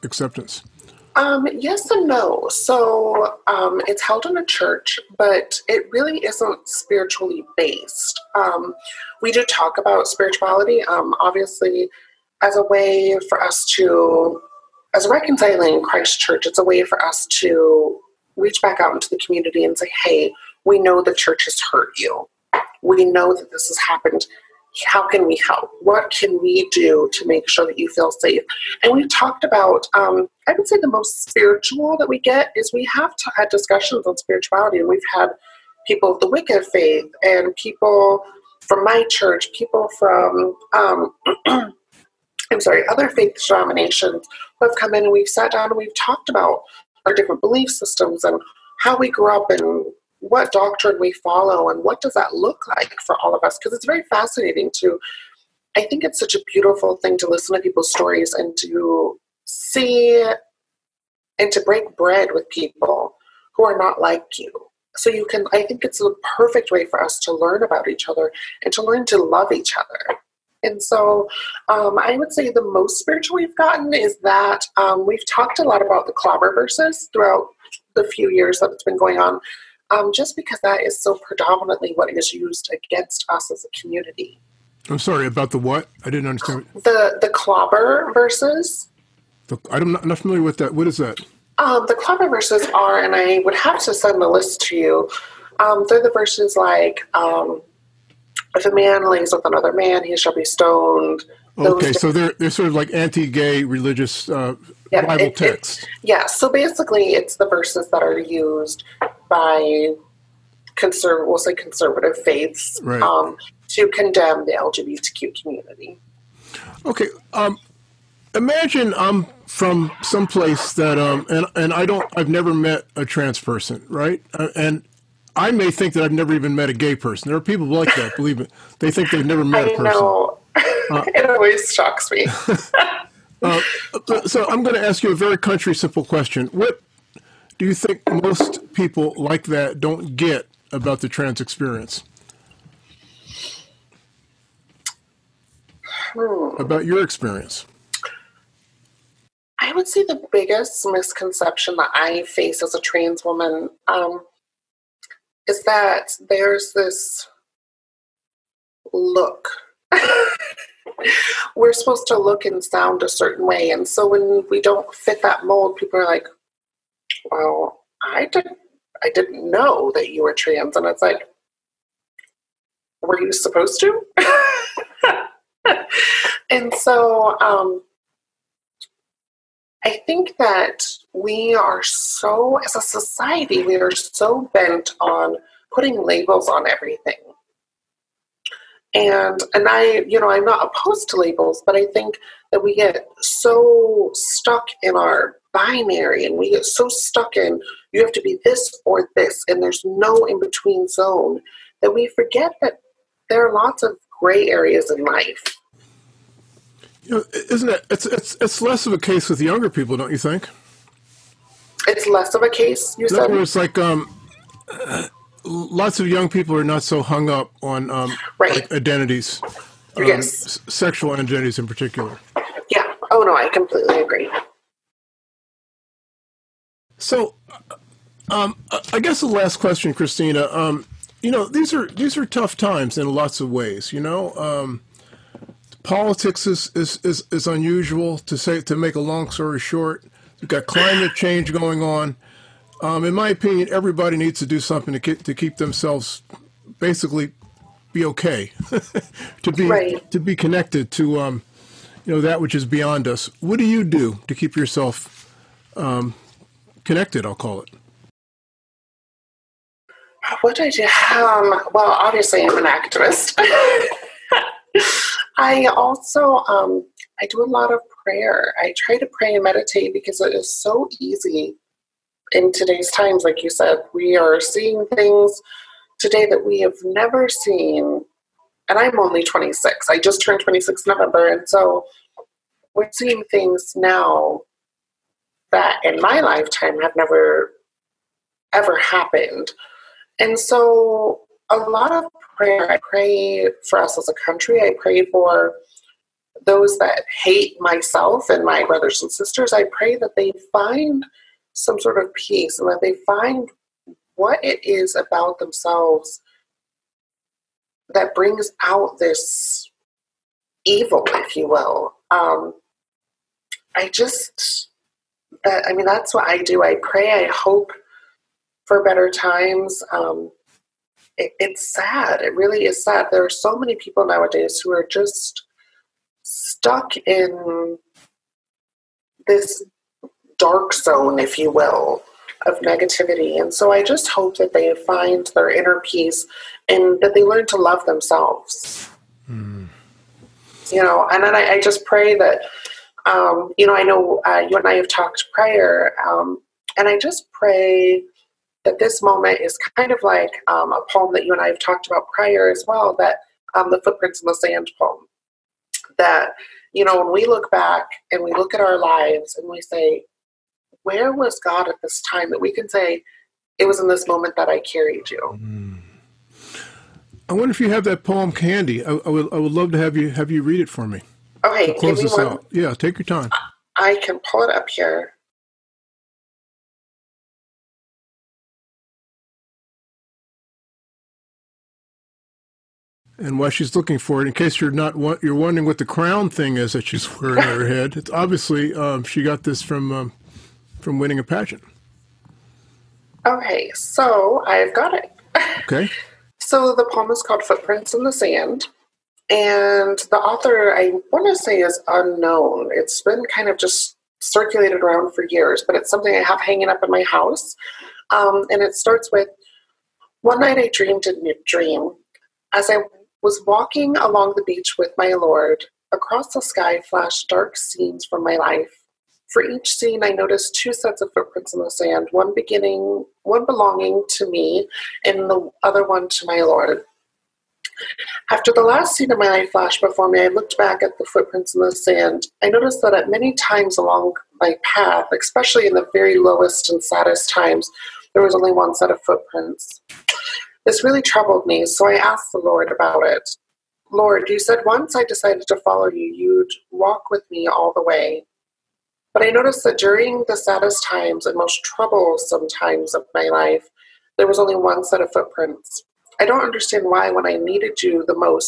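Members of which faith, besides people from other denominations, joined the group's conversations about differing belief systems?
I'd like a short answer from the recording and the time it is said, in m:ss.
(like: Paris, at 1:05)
Wicca, at 0:36.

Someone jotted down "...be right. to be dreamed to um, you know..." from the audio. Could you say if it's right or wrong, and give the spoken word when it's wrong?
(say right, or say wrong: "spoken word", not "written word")
wrong: "connected", not "dreamed".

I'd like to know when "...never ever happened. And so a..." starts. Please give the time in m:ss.
4:46.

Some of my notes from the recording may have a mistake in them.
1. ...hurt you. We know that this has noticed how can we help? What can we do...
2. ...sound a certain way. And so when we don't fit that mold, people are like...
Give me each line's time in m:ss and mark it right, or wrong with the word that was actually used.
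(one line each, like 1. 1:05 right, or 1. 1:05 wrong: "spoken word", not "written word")
1. 0:21 wrong: "happened", not "noticed"
2. 2:42 right.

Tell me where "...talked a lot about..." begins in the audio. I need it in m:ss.
1:15.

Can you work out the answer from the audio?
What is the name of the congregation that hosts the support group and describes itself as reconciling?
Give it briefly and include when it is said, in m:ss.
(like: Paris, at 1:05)
Christ Church, at 0:15.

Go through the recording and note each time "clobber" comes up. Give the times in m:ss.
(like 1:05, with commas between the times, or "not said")
1:16, 1:27, 1:31.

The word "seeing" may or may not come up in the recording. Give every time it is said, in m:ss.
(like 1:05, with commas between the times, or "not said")
4:34, 4:42.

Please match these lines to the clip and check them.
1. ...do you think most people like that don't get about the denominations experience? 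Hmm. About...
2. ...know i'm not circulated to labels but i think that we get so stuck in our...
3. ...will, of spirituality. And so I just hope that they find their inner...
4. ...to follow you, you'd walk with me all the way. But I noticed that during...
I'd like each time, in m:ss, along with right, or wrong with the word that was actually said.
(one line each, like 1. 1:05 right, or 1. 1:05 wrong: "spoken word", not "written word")
1. 2:17 wrong: "trans", not "denominations"
2. 3:10 wrong: "opposed", not "circulated"
3. 5:31 wrong: "negativity", not "spirituality"
4. 7:25 right.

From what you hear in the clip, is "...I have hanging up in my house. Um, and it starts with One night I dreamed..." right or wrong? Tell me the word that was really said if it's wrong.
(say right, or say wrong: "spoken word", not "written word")
right.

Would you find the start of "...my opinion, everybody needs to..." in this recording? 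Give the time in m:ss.
4:03.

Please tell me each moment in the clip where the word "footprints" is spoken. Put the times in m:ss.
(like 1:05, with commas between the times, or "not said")
5:53, 6:37, 7:01, 7:11, 7:19, 7:35.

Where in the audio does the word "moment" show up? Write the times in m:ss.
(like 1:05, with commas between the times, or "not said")
5:49, 6:04.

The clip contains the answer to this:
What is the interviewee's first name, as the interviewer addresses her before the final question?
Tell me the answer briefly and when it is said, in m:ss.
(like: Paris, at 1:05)
Christina, at 3:49.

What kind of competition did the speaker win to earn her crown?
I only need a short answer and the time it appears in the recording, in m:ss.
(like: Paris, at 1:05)
a pageant, at 6:31.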